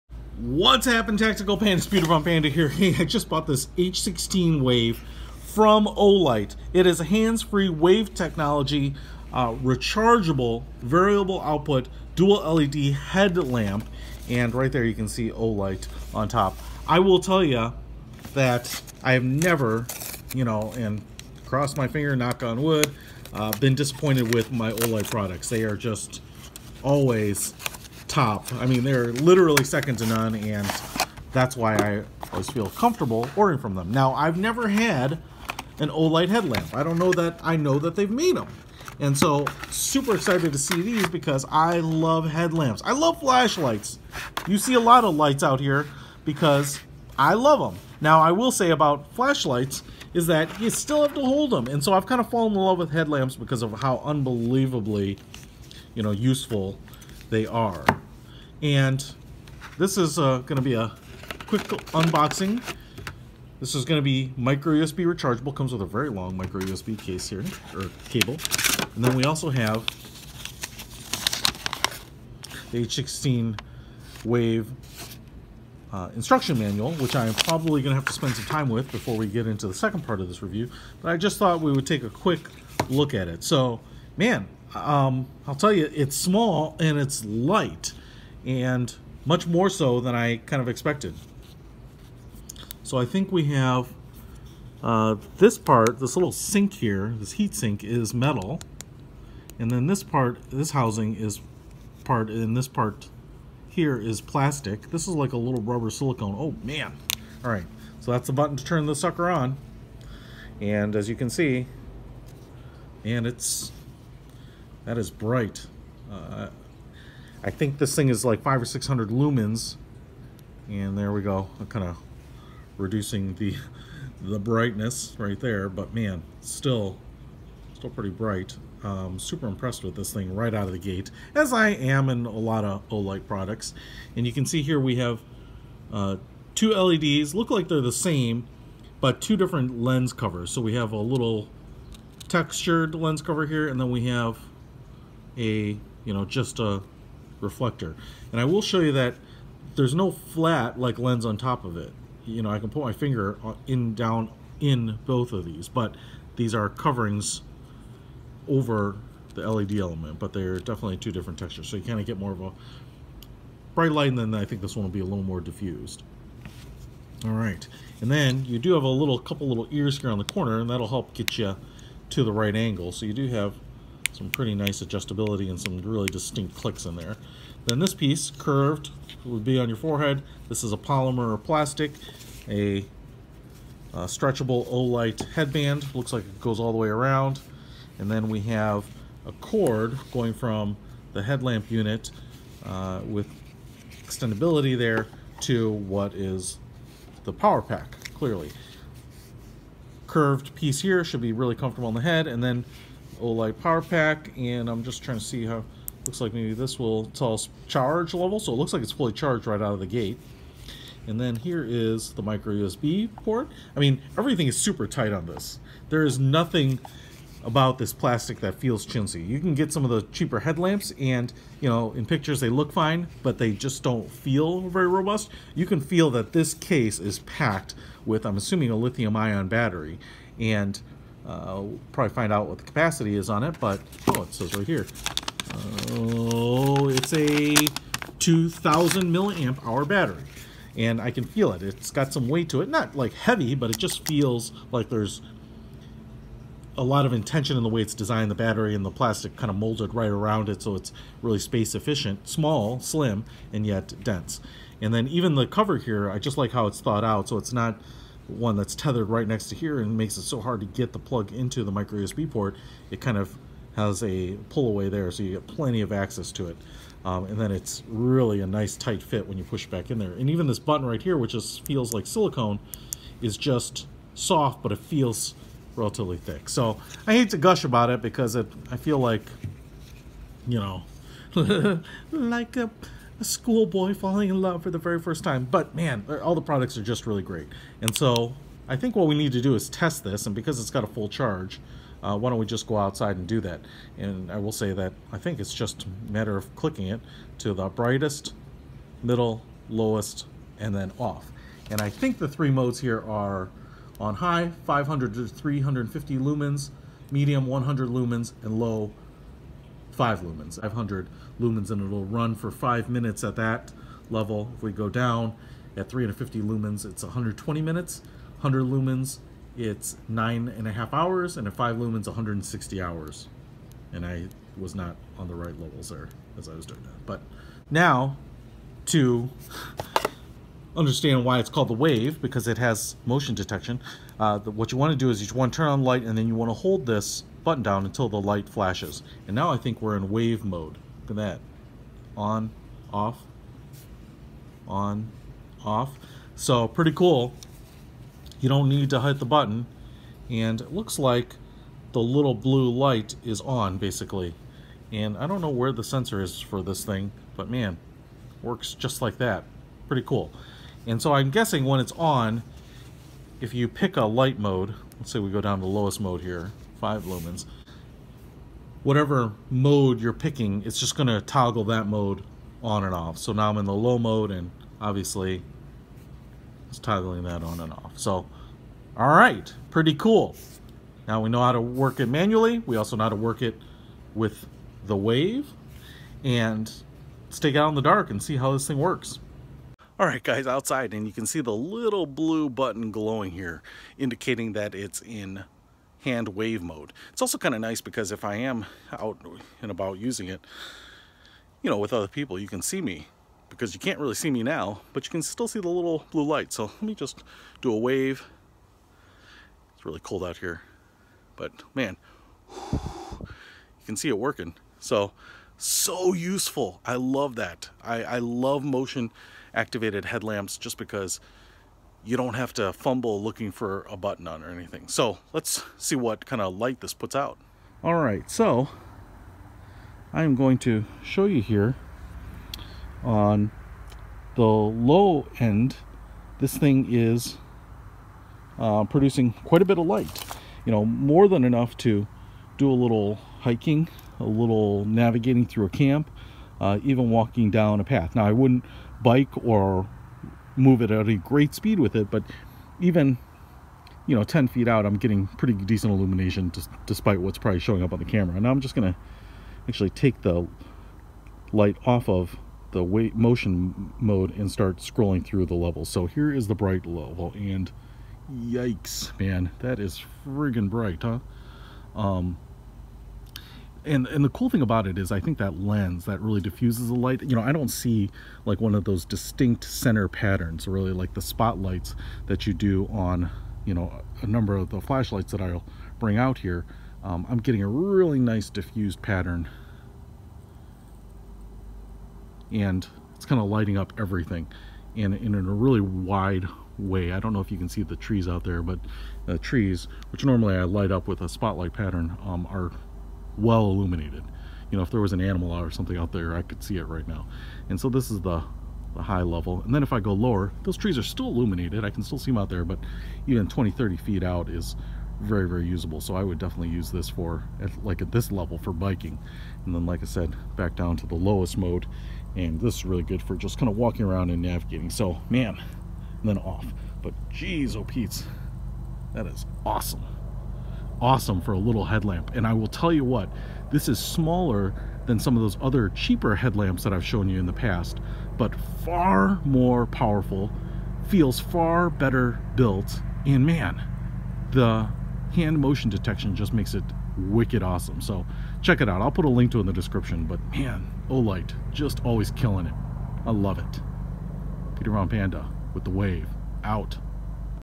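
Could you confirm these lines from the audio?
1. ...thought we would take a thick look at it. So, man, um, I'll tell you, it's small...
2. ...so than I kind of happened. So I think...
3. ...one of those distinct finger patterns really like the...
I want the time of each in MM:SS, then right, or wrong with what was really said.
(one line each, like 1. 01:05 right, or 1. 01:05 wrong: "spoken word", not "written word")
1. 01:21 wrong: "quick", not "thick"
2. 01:29 wrong: "expected", not "happened"
3. 07:58 wrong: "center", not "finger".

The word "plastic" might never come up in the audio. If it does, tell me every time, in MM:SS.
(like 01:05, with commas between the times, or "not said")
01:44, 03:01, 03:37, 04:08.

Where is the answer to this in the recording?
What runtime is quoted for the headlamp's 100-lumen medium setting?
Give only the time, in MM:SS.
05:20.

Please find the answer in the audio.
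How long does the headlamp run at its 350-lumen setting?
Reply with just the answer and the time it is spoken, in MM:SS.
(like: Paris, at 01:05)
120 minutes, at 05:17.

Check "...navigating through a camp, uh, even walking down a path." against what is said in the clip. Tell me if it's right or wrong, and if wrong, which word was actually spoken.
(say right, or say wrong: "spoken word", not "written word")
right.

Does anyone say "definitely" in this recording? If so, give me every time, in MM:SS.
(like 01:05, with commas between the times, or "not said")
02:40, 08:36.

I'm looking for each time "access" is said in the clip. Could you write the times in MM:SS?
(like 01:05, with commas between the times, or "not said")
04:25.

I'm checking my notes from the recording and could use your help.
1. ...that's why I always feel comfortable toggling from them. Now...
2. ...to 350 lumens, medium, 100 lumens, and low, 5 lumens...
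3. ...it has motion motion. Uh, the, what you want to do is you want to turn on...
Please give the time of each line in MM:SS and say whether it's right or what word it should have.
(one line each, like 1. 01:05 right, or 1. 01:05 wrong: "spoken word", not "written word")
1. 00:31 wrong: "ordering", not "toggling"
2. 05:05 right
3. 05:32 wrong: "detection", not "motion".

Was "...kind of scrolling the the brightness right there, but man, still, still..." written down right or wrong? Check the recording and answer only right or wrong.
wrong.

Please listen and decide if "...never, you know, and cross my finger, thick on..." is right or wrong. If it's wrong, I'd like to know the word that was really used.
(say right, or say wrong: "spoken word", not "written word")
wrong: "knock", not "thick".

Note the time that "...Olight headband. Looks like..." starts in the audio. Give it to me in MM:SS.
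03:04.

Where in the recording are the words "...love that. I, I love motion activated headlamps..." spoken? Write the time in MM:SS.
06:56.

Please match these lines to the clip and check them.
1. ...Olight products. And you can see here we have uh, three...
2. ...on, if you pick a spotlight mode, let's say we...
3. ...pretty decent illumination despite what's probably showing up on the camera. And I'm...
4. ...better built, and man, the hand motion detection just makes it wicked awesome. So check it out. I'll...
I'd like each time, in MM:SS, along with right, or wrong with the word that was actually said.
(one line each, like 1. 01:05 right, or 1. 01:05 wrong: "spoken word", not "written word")
1. 02:12 wrong: "two", not "three"
2. 06:01 wrong: "light", not "spotlight"
3. 07:35 right
4. 09:01 right.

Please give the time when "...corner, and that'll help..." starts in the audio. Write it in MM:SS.
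02:50.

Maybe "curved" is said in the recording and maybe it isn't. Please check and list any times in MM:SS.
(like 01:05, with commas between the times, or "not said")
02:58, 03:20.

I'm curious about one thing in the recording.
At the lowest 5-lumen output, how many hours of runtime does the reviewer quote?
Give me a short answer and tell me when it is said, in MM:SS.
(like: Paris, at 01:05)
160 hours, at 05:22.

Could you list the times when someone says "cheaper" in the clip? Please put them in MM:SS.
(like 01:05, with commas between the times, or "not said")
03:40, 08:55.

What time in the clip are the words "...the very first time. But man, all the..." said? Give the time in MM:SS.
04:44.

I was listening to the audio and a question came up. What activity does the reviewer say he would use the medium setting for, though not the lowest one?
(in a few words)
biking.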